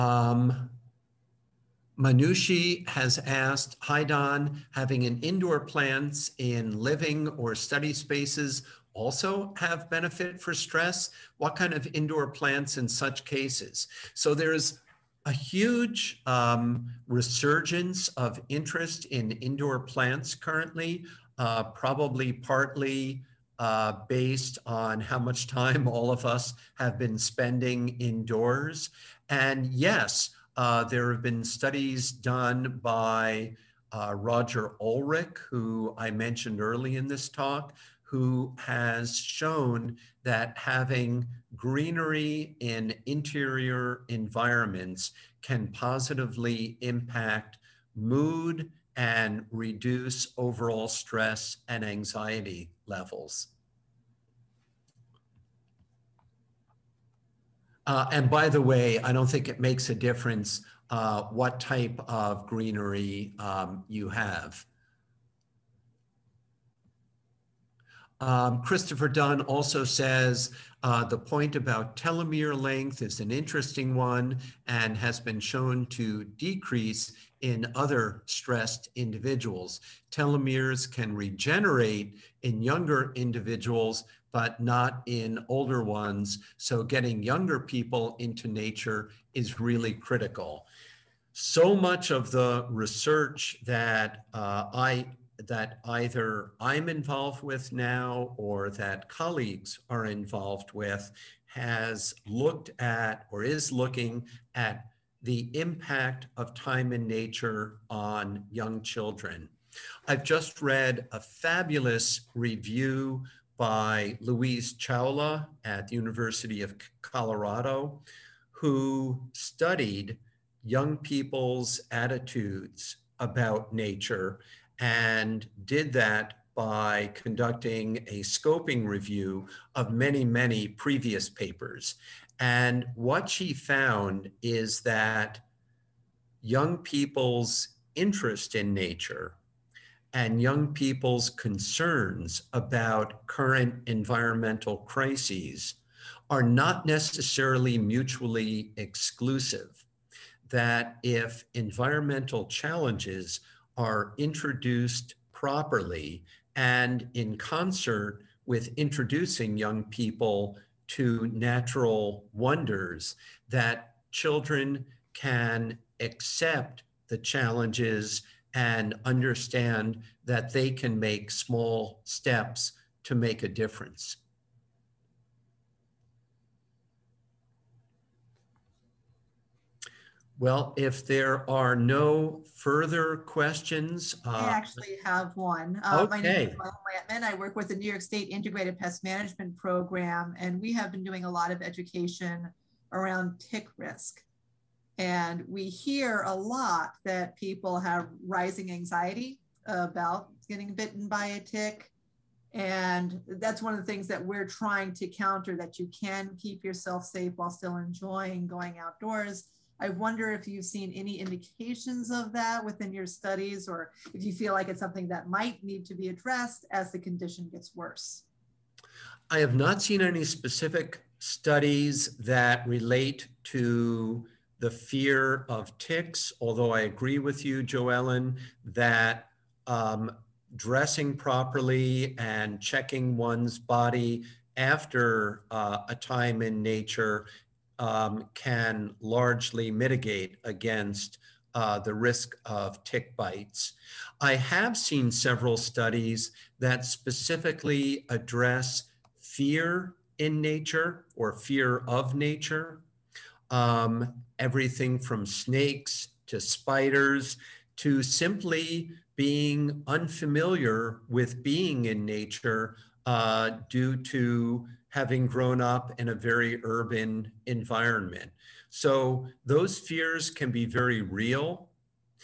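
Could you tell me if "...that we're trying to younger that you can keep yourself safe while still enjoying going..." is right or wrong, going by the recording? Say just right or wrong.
wrong.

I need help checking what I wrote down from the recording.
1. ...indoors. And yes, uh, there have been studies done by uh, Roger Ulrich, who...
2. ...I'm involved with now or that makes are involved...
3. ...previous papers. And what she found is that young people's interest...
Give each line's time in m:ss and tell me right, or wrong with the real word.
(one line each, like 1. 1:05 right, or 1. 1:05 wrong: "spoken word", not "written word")
1. 0:27 right
2. 1:36 wrong: "colleagues", not "makes"
3. 2:10 right.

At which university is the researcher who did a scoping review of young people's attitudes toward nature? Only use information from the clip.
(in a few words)
University of Colorado.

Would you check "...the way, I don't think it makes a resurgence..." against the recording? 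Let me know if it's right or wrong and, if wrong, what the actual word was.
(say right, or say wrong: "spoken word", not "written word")
wrong: "difference", not "resurgence".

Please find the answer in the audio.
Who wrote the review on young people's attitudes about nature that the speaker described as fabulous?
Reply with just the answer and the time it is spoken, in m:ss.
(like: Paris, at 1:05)
Louise Chawla, at 1:54.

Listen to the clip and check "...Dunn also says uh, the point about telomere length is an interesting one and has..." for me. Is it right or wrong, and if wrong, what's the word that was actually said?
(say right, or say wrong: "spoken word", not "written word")
right.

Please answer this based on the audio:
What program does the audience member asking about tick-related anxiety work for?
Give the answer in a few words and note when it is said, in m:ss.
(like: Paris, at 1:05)
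New York State Integrated Pest Management Program, at 3:07.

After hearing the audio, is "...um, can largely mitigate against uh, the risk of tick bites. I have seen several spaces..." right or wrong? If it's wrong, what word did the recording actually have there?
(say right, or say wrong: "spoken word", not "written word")
wrong: "studies", not "spaces".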